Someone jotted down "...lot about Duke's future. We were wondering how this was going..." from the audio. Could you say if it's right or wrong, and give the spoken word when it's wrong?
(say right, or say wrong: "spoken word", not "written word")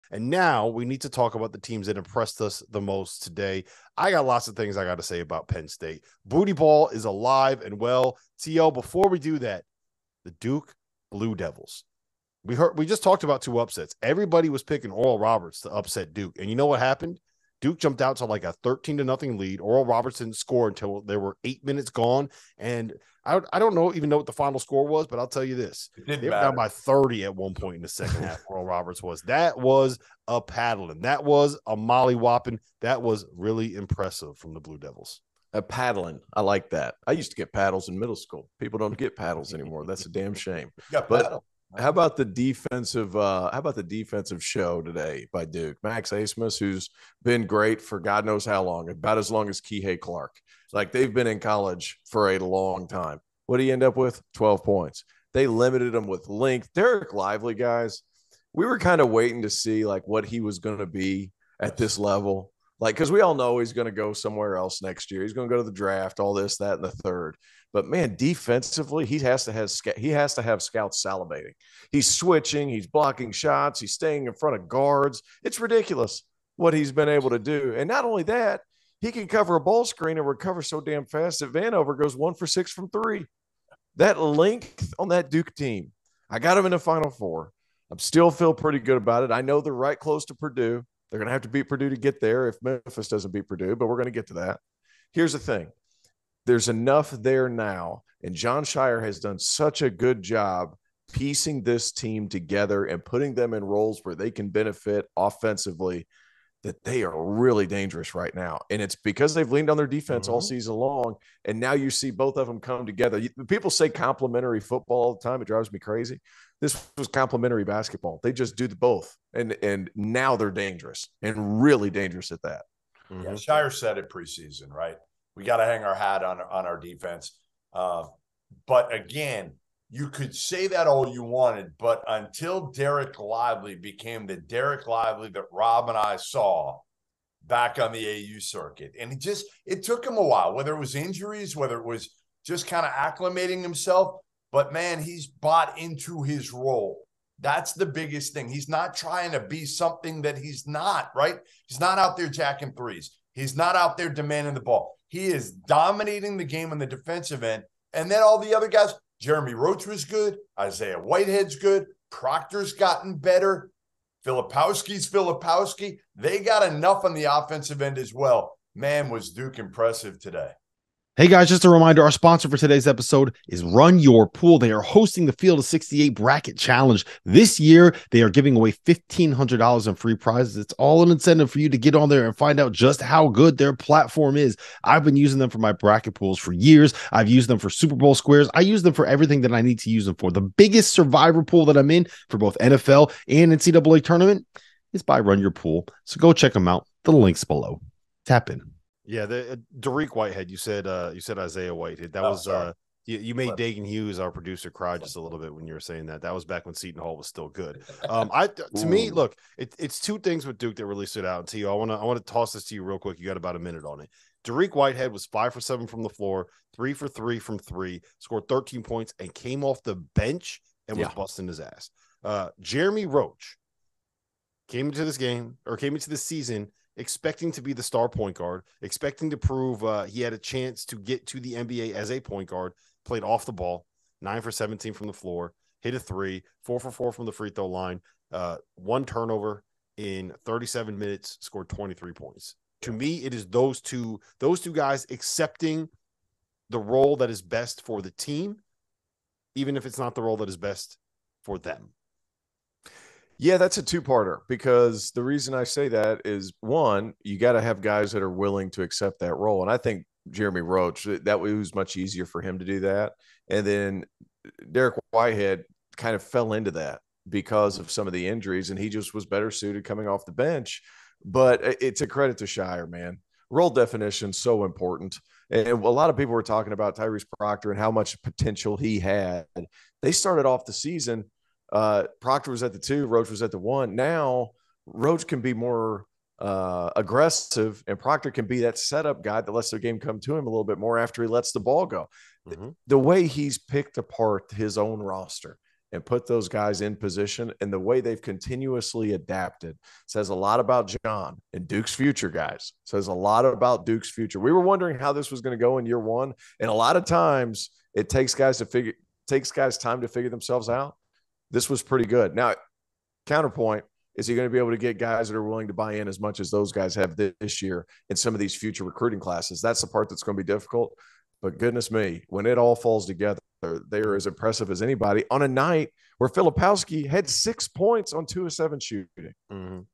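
right.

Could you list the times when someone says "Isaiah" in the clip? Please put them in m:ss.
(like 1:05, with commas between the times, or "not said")
2:40, 3:21.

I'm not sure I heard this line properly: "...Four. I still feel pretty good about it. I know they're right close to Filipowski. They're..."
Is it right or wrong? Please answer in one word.
wrong.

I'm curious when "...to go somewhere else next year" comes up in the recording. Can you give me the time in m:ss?
1:03.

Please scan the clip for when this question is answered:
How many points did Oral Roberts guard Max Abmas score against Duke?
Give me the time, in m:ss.
0:54.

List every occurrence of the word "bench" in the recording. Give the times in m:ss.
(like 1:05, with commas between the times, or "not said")
3:40, 4:30.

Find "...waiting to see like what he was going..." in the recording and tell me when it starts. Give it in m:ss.
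0:59.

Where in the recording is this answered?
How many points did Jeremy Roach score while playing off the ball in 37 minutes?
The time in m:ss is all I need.
4:01.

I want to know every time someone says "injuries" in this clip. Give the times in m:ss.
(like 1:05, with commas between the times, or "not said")
2:20, 4:28.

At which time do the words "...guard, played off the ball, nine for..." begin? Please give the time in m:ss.
3:52.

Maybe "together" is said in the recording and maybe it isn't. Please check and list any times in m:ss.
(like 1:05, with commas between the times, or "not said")
1:42, 1:52, 5:23.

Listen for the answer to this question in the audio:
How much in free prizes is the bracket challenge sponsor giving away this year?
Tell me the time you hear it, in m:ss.
2:58.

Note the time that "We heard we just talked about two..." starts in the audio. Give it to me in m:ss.
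0:12.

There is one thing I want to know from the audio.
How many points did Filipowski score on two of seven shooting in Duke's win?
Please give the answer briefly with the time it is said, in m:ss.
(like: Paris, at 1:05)
6, at 5:27.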